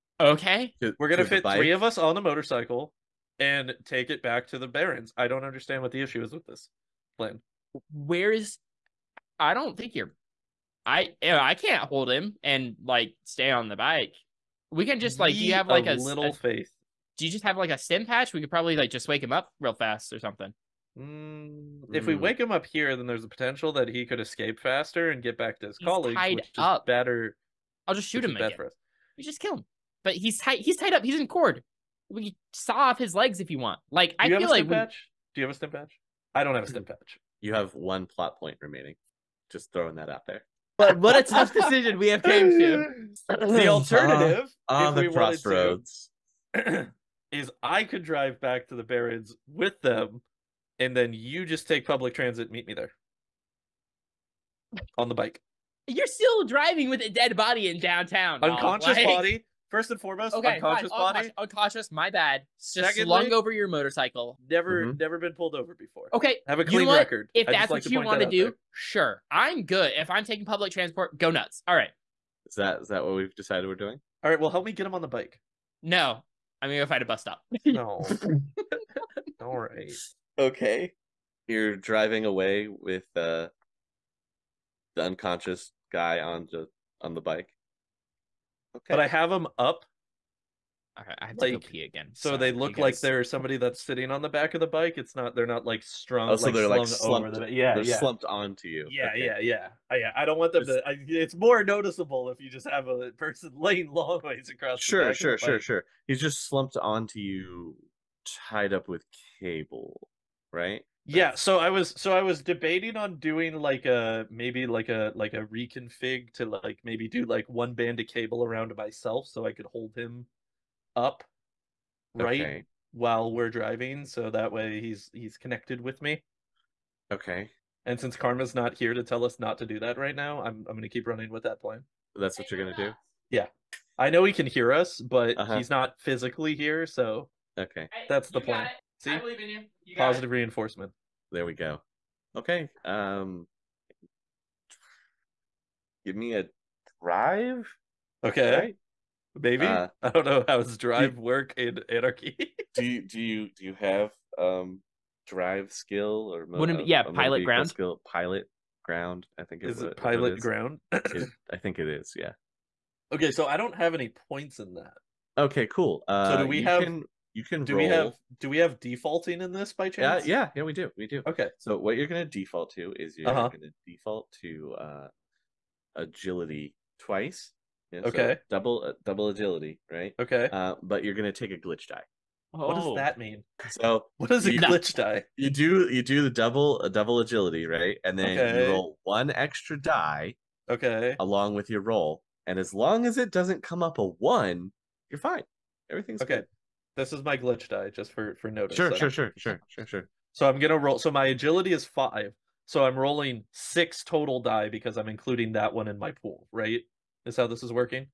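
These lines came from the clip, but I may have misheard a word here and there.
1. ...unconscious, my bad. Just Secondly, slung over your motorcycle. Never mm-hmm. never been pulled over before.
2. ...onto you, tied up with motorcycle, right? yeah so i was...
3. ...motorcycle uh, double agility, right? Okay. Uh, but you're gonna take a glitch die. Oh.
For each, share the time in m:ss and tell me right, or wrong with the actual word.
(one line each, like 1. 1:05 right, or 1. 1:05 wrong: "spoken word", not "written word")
1. 1:01 right
2. 1:46 wrong: "cable", not "motorcycle"
3. 2:58 wrong: "double", not "motorcycle".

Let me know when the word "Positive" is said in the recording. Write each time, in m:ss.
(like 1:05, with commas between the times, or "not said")
2:19.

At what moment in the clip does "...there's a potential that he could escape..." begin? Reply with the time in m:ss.
0:23.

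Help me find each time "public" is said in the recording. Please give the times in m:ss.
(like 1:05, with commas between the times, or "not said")
0:51, 1:10.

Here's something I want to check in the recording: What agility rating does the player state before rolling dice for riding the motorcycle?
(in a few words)
5.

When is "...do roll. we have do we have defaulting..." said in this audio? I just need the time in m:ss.
2:47.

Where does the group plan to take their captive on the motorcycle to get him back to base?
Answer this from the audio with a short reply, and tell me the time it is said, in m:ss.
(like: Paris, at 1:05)
The Barrens, at 0:04.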